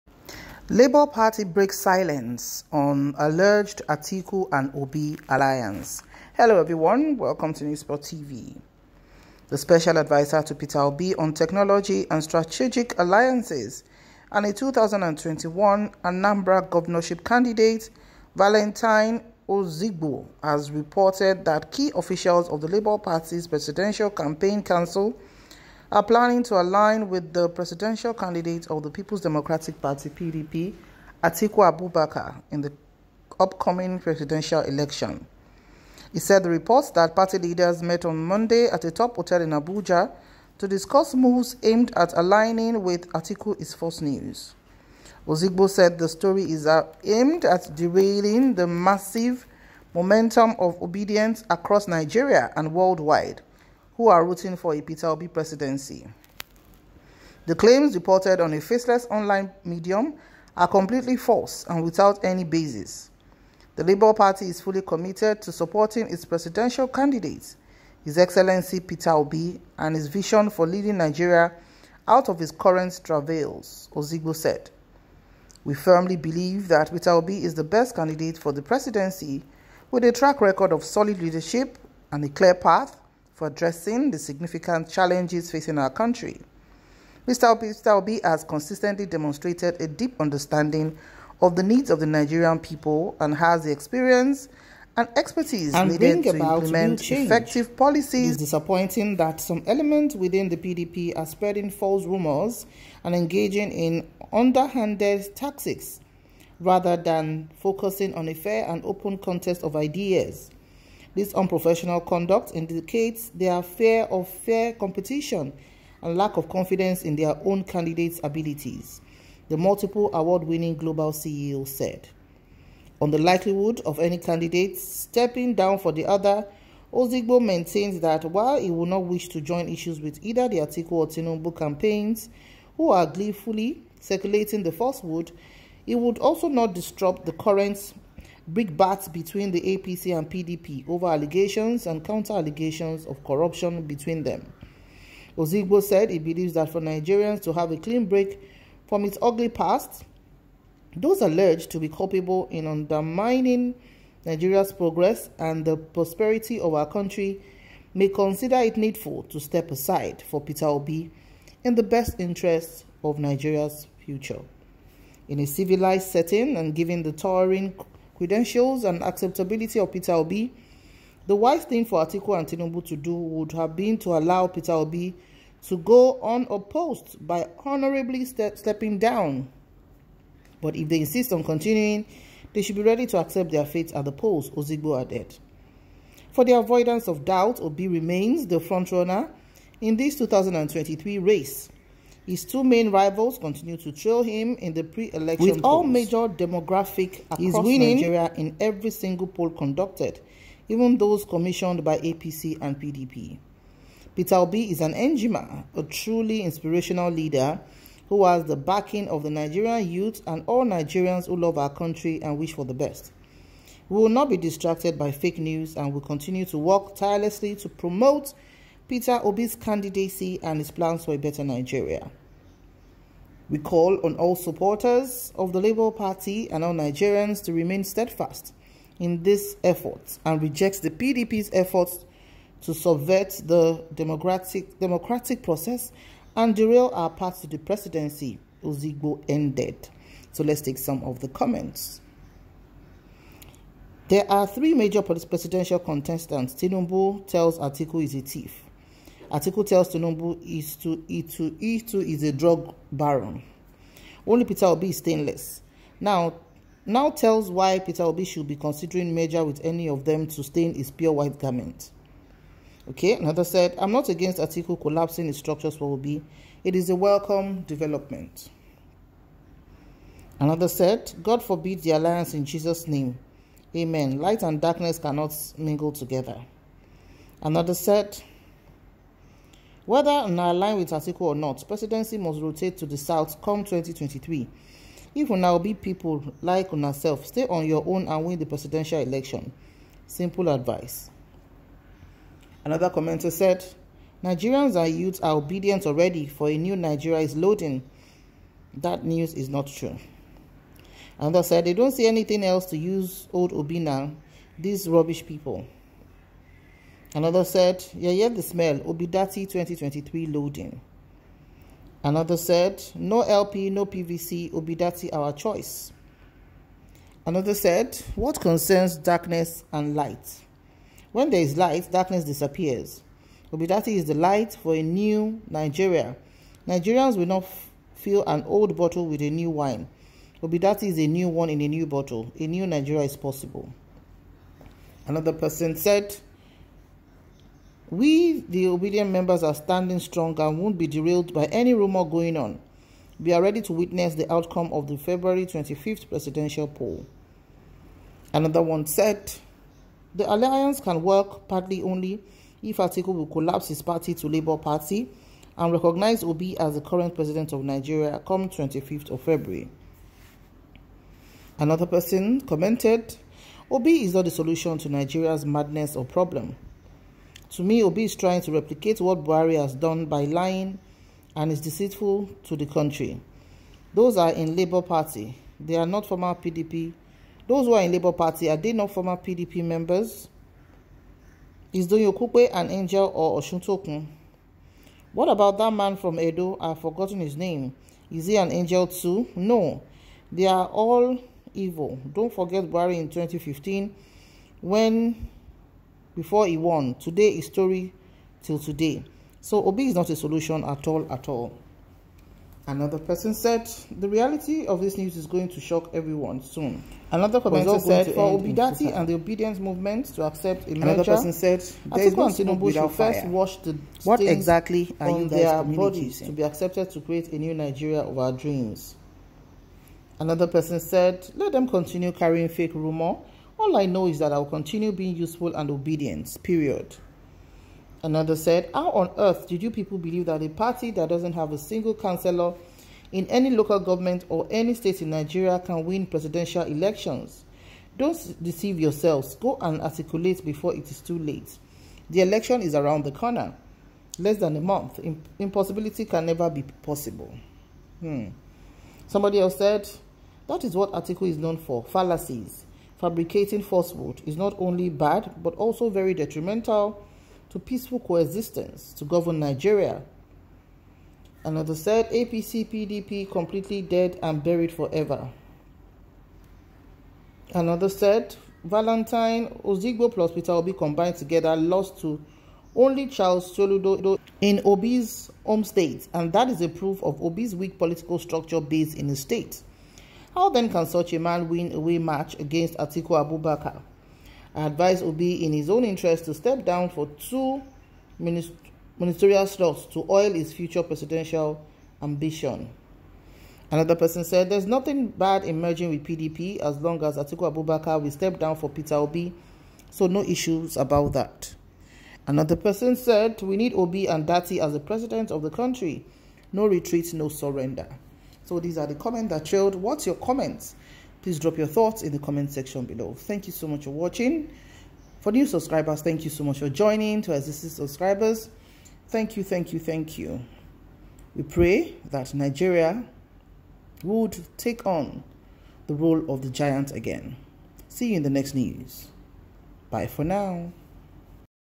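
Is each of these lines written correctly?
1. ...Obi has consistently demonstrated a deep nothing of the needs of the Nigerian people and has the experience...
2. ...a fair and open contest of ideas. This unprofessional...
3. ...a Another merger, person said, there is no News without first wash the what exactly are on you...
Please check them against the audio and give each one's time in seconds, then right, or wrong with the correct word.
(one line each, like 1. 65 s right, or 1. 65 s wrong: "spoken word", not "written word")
1. 87 s wrong: "understanding", not "nothing"
2. 108 s right
3. 410 s wrong: "Tinubu", not "News".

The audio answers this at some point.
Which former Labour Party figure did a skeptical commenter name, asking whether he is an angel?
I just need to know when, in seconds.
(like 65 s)
381 s.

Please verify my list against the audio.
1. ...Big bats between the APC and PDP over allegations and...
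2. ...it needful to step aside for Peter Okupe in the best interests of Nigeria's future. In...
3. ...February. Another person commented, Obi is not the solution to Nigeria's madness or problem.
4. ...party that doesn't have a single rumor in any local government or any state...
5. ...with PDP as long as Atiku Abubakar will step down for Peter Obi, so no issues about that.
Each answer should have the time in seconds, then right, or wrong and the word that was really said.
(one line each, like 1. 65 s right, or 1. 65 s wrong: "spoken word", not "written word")
1. 138 s right
2. 158 s wrong: "Obi", not "Okupe"
3. 359 s right
4. 430 s wrong: "councillor", not "rumor"
5. 495 s right.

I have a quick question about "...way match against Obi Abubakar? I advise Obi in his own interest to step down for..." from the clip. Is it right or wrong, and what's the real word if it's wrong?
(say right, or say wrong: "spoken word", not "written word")
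wrong: "Atiku", not "Obi".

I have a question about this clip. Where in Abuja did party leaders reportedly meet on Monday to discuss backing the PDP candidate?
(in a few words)
a top hotel.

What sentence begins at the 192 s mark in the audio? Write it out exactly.
His two main rivals continue to trail him in the pre-election With polls.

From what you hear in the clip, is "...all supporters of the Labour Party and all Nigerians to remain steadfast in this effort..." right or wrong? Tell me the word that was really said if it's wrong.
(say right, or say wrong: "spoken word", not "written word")
right.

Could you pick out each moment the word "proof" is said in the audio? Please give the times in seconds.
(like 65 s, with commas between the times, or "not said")
476 s.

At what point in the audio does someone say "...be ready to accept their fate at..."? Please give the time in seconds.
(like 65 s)
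182 s.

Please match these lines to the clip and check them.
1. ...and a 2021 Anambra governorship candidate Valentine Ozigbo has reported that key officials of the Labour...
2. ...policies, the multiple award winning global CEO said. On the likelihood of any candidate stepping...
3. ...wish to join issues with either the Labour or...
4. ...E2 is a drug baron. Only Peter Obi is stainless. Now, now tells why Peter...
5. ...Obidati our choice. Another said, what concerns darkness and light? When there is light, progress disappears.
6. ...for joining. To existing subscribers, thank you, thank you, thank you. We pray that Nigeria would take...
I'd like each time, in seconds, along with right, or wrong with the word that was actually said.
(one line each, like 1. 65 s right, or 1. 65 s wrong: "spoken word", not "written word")
1. 14 s right
2. 118 s wrong: "abilities", not "policies"
3. 129 s wrong: "Atiku", not "Labour"
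4. 251 s right
5. 314 s wrong: "darkness", not "progress"
6. 516 s right.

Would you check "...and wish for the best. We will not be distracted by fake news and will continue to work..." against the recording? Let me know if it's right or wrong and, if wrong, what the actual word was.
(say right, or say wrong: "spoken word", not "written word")
right.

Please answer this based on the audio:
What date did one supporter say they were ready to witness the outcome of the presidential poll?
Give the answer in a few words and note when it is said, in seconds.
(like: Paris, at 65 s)
25 February, at 344 s.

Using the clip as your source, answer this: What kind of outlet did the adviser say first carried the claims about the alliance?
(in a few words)
a faceless online medium.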